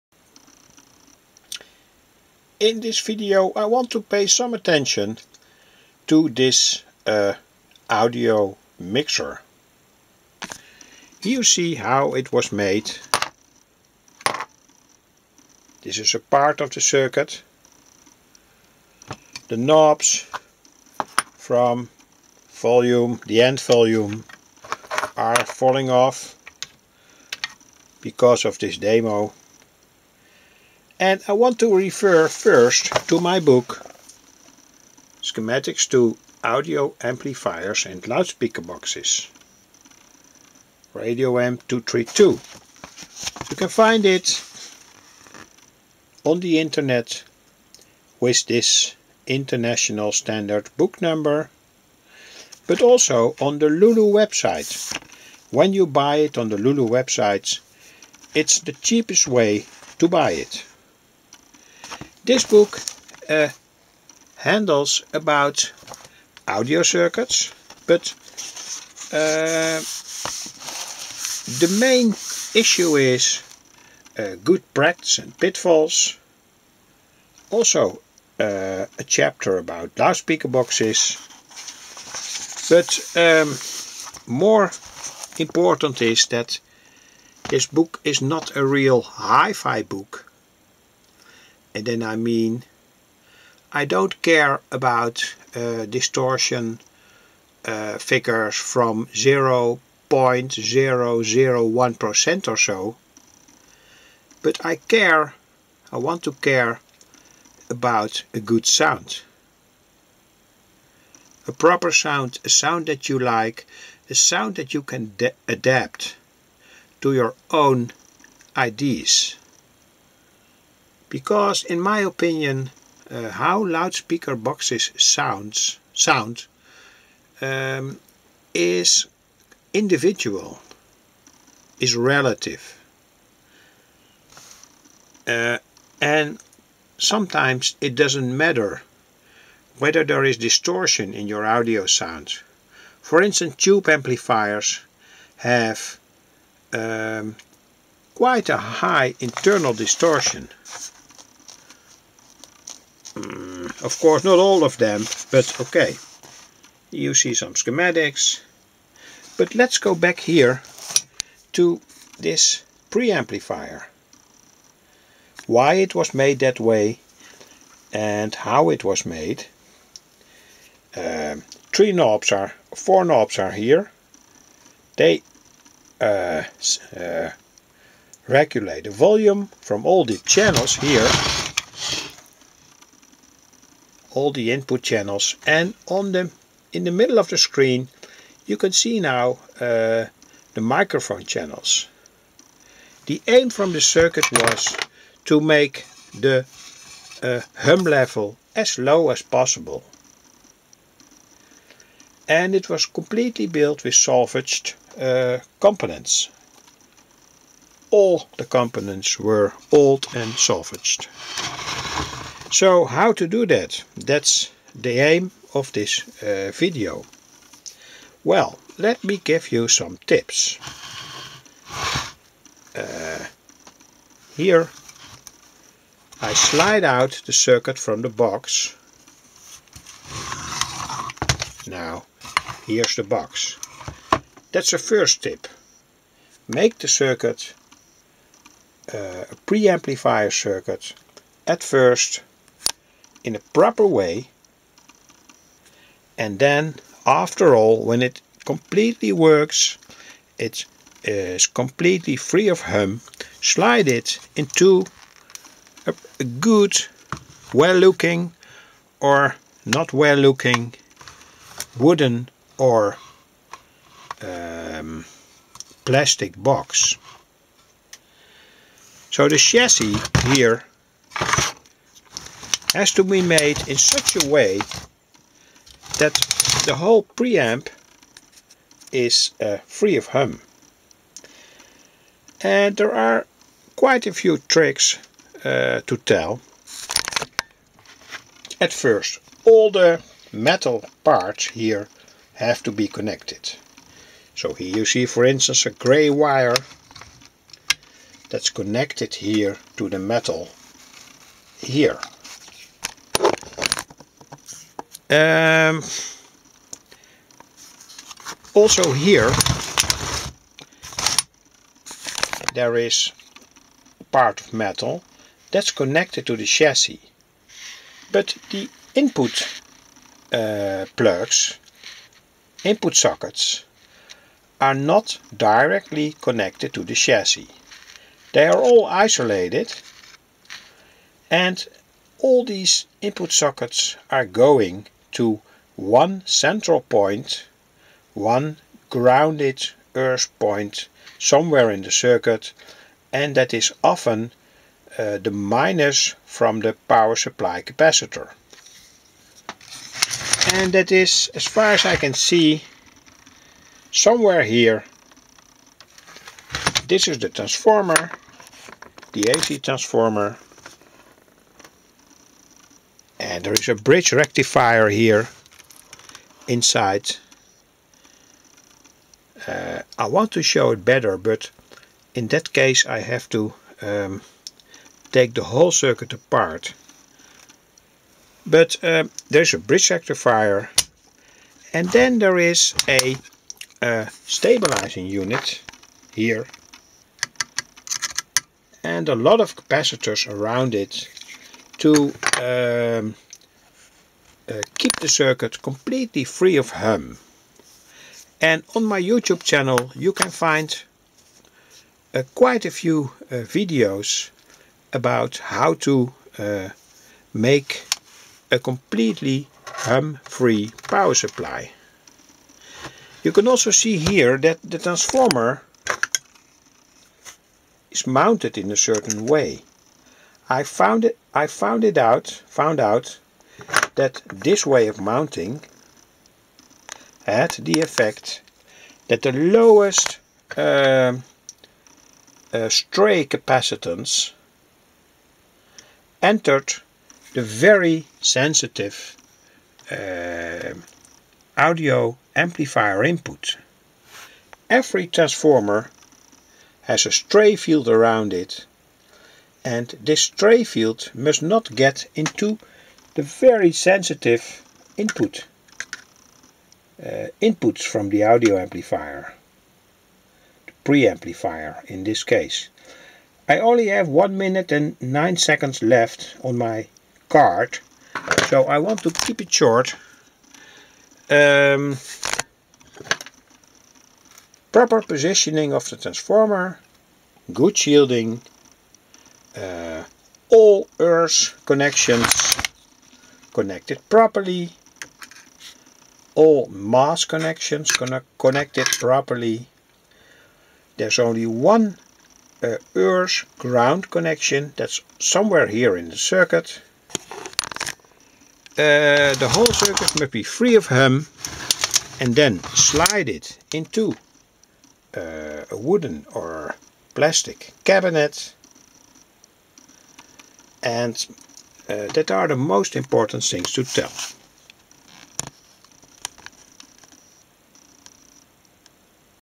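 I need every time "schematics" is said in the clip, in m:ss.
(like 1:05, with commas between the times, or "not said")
0:35, 2:37.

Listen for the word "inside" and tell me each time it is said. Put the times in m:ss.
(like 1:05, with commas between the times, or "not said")
6:06.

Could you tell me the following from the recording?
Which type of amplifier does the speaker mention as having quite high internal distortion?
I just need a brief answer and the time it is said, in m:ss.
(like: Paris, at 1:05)
Tube amplifiers, at 2:23.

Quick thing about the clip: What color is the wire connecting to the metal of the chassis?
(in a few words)
Grey.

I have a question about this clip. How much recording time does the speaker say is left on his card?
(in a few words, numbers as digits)
1 minute and 9 seconds.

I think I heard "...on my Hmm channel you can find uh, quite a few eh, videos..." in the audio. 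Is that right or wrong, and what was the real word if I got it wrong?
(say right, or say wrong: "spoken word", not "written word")
wrong: "YouTube", not "Hmm".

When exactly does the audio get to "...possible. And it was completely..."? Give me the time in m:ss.
3:19.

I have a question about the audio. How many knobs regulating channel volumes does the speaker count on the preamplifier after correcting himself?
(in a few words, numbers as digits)
4.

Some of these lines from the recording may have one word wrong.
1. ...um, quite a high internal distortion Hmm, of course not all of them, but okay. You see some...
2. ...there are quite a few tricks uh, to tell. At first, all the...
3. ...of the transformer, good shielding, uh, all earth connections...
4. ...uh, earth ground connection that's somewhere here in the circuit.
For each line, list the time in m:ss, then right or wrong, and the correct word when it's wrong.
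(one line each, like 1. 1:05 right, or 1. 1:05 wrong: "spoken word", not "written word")
1. 2:26 right
2. 4:42 right
3. 7:55 right
4. 8:12 right.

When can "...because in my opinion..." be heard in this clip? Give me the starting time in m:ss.
2:01.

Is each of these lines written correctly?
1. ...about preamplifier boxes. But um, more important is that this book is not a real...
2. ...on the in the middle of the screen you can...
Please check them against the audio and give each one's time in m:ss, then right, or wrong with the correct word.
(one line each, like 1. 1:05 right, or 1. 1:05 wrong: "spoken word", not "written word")
1. 1:19 wrong: "loudspeaker", not "preamplifier"
2. 3:05 right.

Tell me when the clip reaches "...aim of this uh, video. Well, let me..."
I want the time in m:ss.
3:34.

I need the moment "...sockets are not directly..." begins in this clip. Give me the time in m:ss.
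5:22.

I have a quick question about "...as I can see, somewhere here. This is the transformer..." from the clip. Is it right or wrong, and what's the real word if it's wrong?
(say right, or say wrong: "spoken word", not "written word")
right.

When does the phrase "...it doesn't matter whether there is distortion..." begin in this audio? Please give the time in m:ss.
2:17.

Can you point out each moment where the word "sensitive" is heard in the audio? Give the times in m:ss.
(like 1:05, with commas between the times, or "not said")
7:18, 7:33.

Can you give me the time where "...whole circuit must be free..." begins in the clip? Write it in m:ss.
8:19.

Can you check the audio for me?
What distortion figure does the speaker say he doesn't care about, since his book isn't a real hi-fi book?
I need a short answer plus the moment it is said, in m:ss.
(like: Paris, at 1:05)
0.001%, at 1:39.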